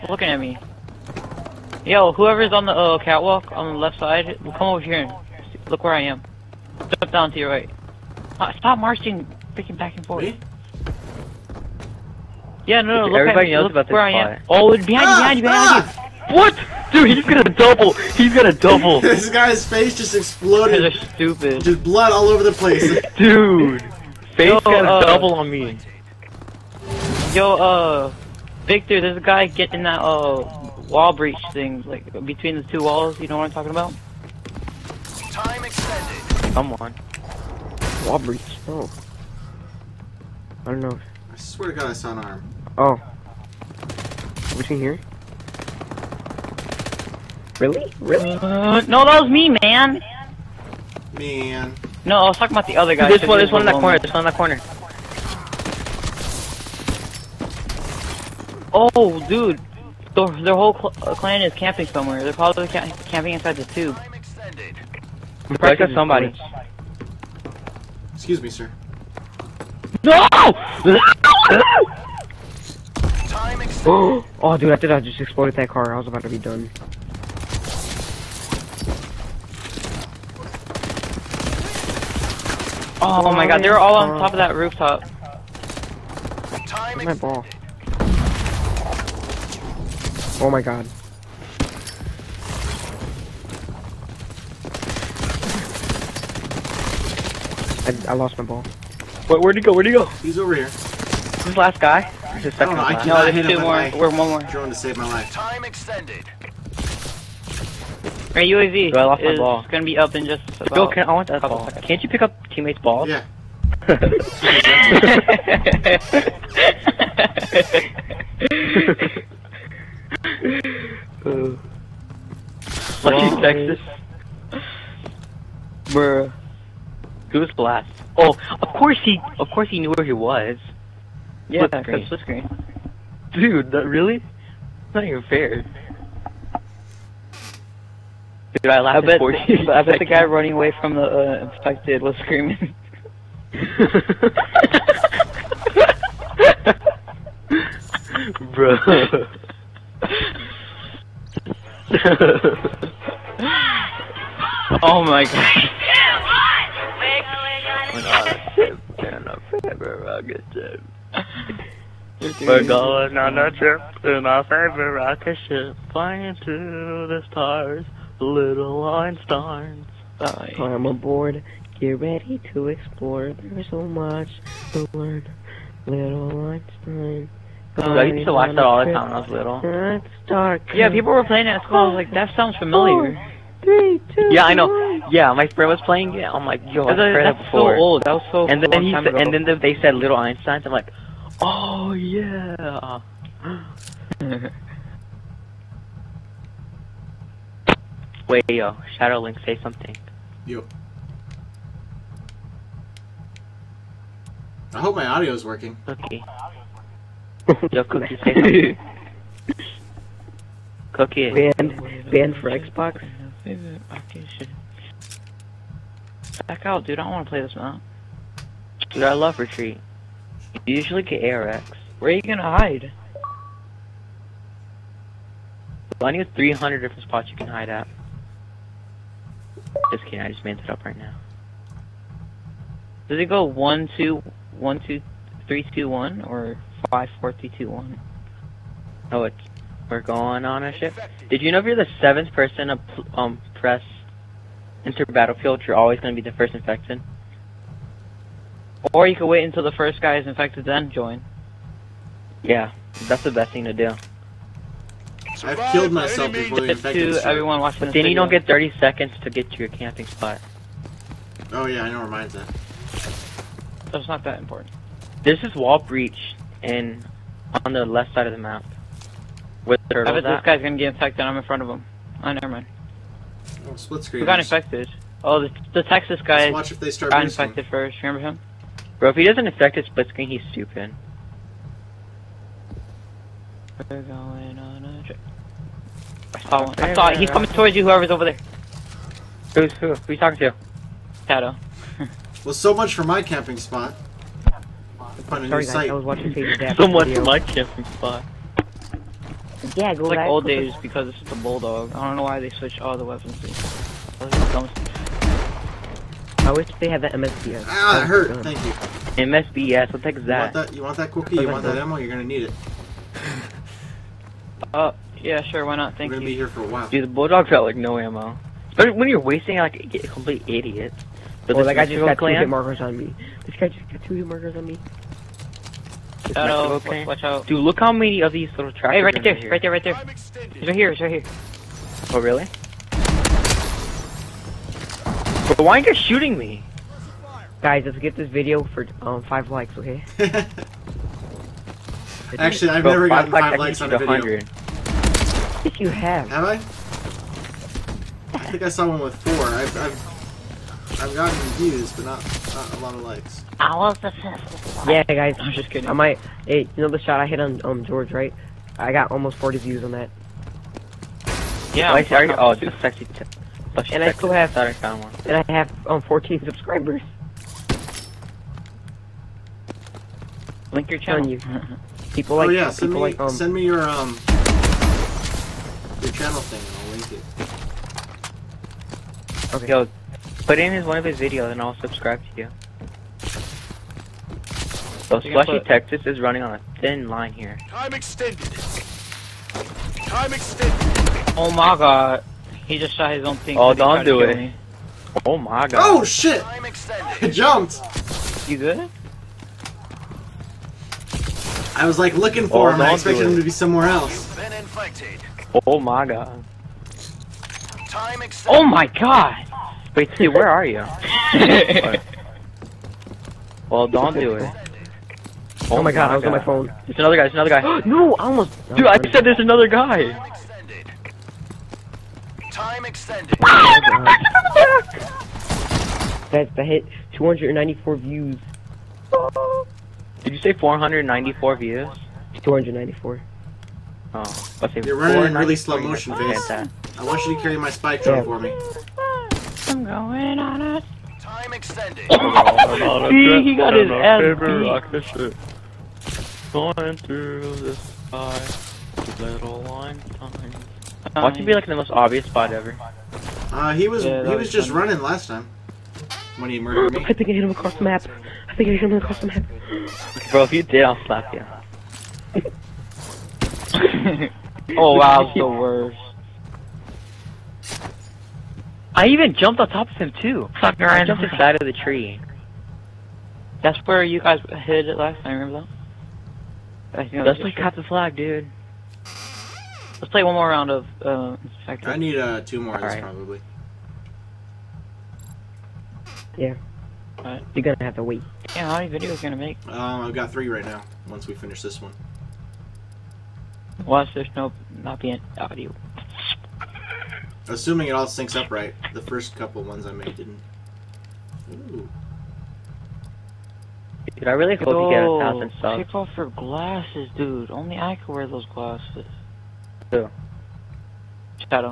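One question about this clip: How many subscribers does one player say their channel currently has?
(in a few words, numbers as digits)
14.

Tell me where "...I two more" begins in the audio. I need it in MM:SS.
01:43.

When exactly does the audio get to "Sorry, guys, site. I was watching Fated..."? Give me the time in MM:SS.
04:55.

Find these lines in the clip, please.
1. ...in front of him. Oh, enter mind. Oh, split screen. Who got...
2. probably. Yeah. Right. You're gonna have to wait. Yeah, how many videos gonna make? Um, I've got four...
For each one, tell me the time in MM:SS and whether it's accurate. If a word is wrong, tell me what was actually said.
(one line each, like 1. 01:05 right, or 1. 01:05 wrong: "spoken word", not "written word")
1. 04:31 wrong: "never", not "enter"
2. 08:03 wrong: "three", not "four".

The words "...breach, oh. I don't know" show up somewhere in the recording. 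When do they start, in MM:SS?
00:38.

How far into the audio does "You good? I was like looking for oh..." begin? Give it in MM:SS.
06:38.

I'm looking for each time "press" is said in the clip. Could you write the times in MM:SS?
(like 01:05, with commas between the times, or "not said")
04:03.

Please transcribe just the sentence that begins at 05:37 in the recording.
Guys, let's get this video for um, five likes, okay?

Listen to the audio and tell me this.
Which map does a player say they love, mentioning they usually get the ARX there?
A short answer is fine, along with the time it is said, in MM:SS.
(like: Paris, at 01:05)
Retreat, at 03:39.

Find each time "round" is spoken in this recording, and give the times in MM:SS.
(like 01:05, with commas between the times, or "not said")
08:00.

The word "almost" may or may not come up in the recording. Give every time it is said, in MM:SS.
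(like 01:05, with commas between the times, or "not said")
05:59, 06:58.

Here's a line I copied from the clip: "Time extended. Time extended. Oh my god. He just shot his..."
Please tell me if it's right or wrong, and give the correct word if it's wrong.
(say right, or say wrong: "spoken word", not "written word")
right.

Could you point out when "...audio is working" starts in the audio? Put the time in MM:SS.
03:25.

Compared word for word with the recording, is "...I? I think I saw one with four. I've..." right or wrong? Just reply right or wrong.
right.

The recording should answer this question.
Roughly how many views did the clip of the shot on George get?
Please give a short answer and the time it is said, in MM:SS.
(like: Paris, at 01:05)
40, at 05:59.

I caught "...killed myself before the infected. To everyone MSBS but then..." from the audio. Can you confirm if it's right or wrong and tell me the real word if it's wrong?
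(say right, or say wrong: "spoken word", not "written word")
wrong: "Watch", not "MSBS".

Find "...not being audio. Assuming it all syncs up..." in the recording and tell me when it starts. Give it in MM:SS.
08:14.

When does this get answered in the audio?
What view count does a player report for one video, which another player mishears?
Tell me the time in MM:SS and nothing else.
07:07.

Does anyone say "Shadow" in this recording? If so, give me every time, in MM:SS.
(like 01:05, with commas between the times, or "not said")
03:18, 04:51.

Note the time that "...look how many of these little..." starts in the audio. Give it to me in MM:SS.
05:27.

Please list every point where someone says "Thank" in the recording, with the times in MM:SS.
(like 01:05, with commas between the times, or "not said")
05:08, 05:15.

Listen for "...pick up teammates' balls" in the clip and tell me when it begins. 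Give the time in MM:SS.
01:52.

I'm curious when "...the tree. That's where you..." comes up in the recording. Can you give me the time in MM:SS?
07:51.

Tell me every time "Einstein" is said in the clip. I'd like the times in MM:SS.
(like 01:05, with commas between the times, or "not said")
02:48, 02:56, 03:10.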